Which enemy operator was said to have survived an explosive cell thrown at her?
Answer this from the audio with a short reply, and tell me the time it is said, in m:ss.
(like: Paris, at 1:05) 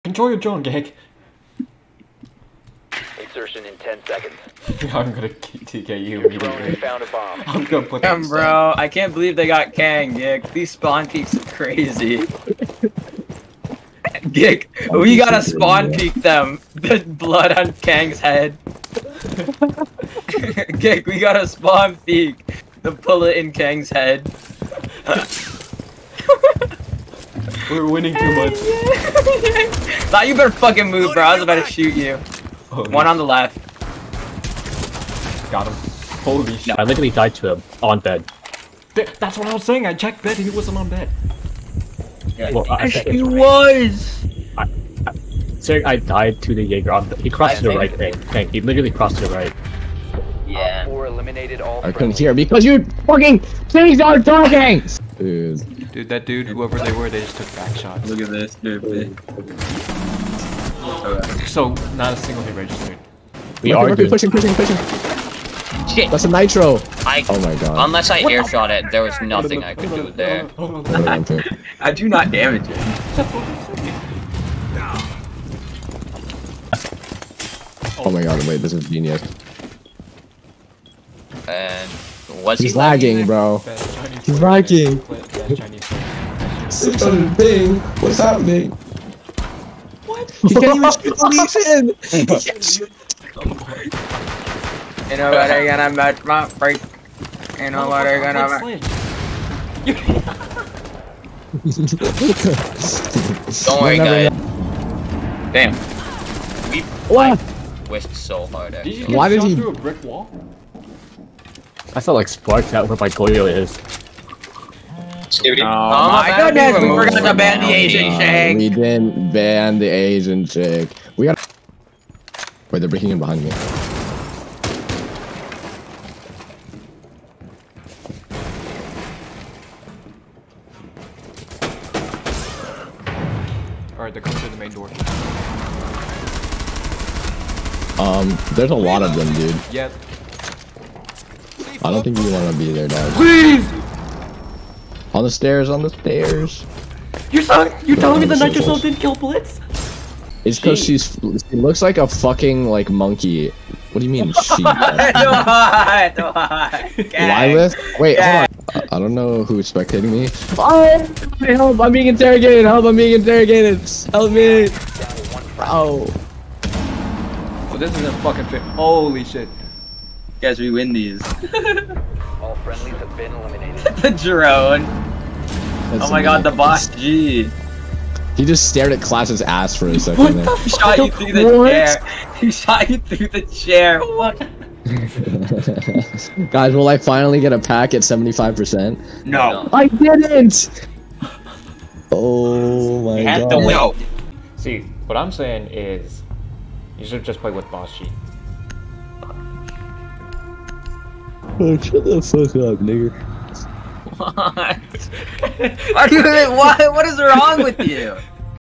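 Blitz, at 2:29.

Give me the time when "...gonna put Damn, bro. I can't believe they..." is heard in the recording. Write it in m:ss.
0:07.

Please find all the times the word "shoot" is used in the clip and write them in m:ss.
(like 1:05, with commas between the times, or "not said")
0:31, 1:30.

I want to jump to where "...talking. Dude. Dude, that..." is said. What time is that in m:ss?
0:54.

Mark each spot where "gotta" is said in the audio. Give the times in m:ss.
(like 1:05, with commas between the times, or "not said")
0:15, 0:21.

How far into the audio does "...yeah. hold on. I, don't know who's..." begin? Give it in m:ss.
2:38.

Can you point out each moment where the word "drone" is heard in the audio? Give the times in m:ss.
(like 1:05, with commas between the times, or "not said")
0:00, 2:54.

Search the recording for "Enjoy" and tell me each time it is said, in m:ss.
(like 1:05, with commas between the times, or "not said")
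0:00.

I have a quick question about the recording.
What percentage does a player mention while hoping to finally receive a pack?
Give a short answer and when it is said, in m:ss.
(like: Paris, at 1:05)
75%, at 3:08.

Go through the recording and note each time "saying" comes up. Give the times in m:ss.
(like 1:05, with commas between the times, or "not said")
0:39, 3:15.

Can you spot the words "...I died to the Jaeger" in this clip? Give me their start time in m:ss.
0:45.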